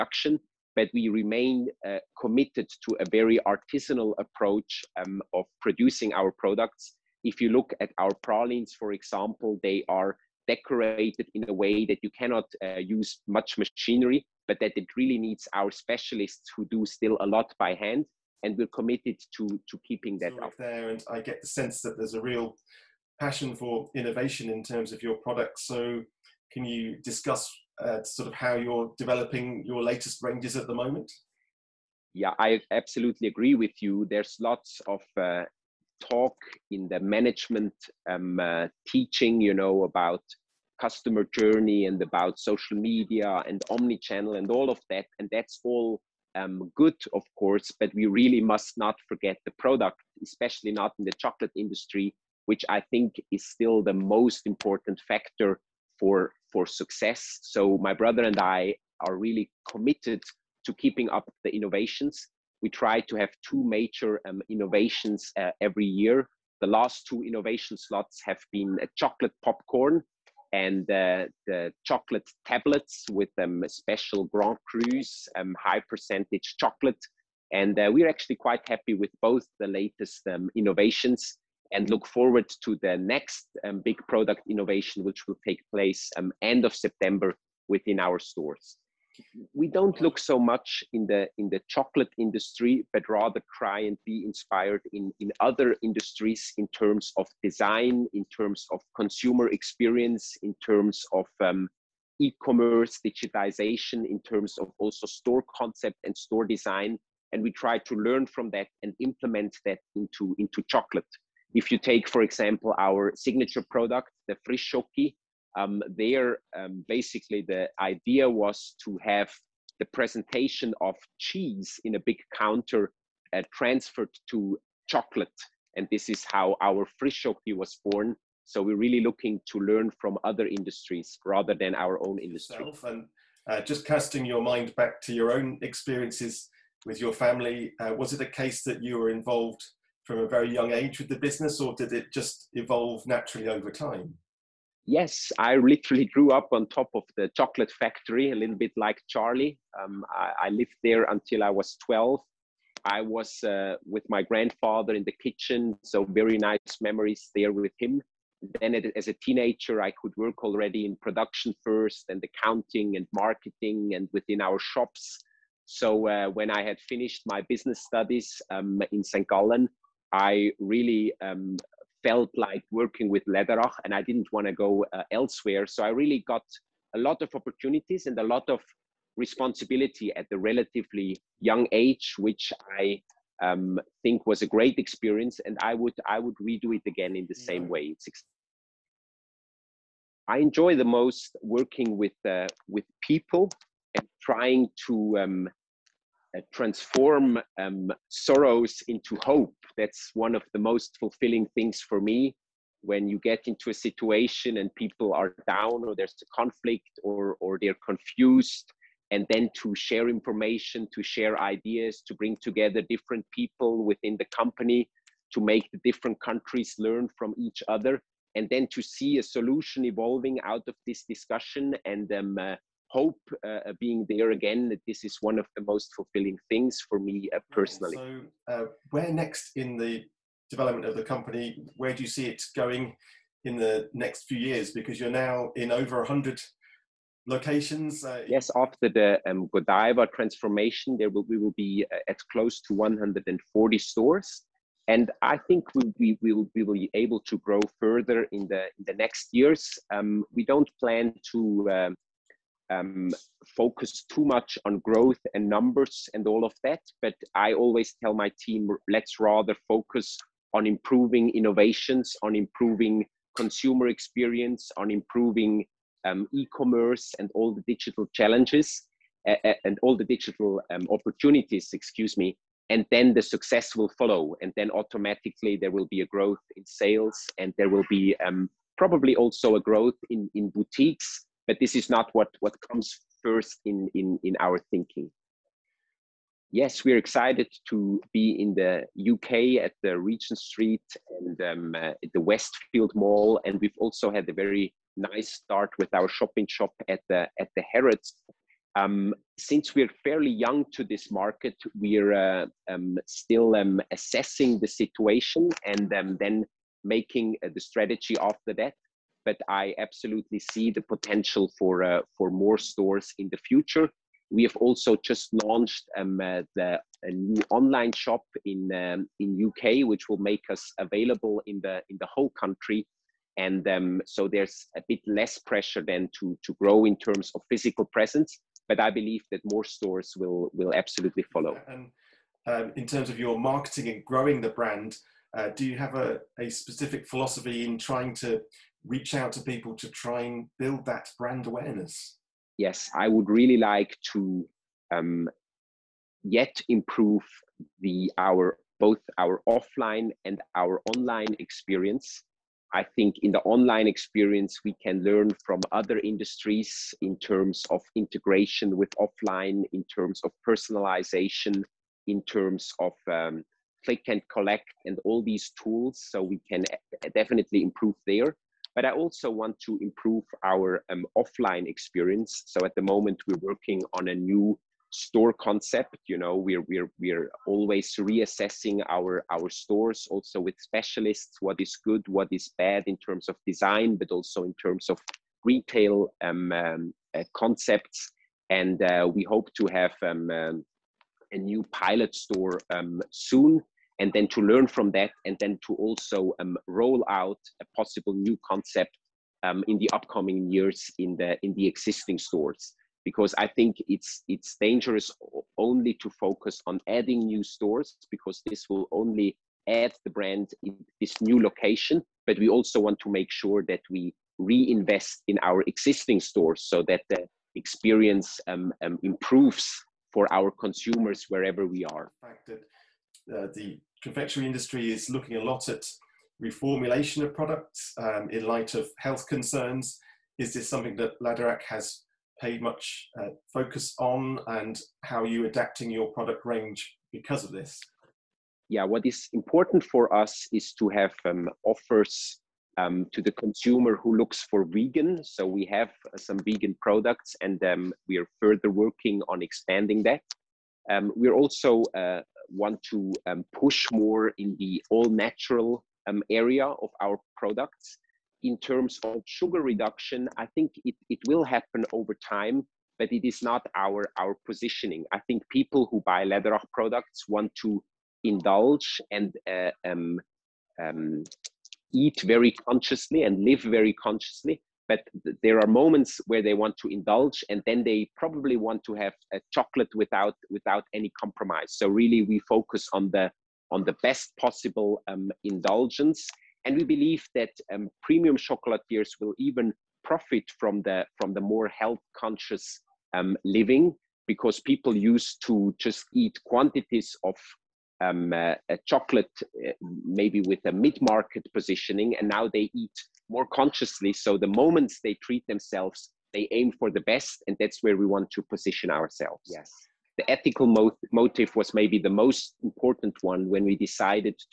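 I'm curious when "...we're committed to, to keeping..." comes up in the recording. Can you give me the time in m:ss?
0:18.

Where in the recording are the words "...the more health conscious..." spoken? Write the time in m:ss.
8:11.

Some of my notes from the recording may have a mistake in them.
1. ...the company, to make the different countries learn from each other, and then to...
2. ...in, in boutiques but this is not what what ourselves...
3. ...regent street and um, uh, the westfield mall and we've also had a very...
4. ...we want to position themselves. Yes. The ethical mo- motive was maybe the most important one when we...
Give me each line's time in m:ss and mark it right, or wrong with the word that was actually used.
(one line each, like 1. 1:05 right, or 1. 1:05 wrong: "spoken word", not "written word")
1. 3:34 right
2. 4:40 wrong: "comes", not "ourselves"
3. 4:49 right
4. 8:27 wrong: "ourselves", not "themselves".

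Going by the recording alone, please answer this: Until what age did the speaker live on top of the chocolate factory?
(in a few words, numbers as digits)
12.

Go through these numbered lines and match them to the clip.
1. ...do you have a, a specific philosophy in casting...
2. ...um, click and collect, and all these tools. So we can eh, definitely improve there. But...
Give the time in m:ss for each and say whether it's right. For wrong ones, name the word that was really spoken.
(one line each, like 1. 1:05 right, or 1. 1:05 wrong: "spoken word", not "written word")
1. 5:35 wrong: "trying", not "casting"
2. 6:03 right.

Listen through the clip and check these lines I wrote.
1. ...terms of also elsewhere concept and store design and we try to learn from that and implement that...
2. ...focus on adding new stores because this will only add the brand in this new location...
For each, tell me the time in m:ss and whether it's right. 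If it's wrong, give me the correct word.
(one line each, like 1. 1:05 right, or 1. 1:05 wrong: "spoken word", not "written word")
1. 1:44 wrong: "store", not "elsewhere"
2. 6:46 right.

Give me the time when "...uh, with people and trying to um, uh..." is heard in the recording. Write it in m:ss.
3:12.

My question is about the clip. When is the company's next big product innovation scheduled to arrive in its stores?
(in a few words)
end of September.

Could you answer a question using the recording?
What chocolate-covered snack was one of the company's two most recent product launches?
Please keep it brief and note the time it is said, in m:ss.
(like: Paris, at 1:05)
chocolate popcorn, at 1:08.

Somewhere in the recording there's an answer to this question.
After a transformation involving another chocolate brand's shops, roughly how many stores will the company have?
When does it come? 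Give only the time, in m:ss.
4:02.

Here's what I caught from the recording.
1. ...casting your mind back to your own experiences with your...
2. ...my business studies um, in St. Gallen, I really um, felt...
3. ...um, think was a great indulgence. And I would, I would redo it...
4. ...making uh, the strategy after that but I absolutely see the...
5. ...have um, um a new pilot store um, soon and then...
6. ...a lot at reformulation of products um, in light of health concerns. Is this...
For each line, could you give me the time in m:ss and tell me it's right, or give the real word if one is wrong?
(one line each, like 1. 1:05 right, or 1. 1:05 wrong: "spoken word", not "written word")
1. 2:13 right
2. 2:47 right
3. 3:03 wrong: "experience", not "indulgence"
4. 5:06 right
5. 6:29 right
6. 7:05 right.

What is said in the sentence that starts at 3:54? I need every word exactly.
Because you're now in over 100 locations.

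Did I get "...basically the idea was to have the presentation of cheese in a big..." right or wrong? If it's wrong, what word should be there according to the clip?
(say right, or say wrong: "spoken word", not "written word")
right.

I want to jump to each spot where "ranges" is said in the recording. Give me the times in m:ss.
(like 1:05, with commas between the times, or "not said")
0:30, 7:16.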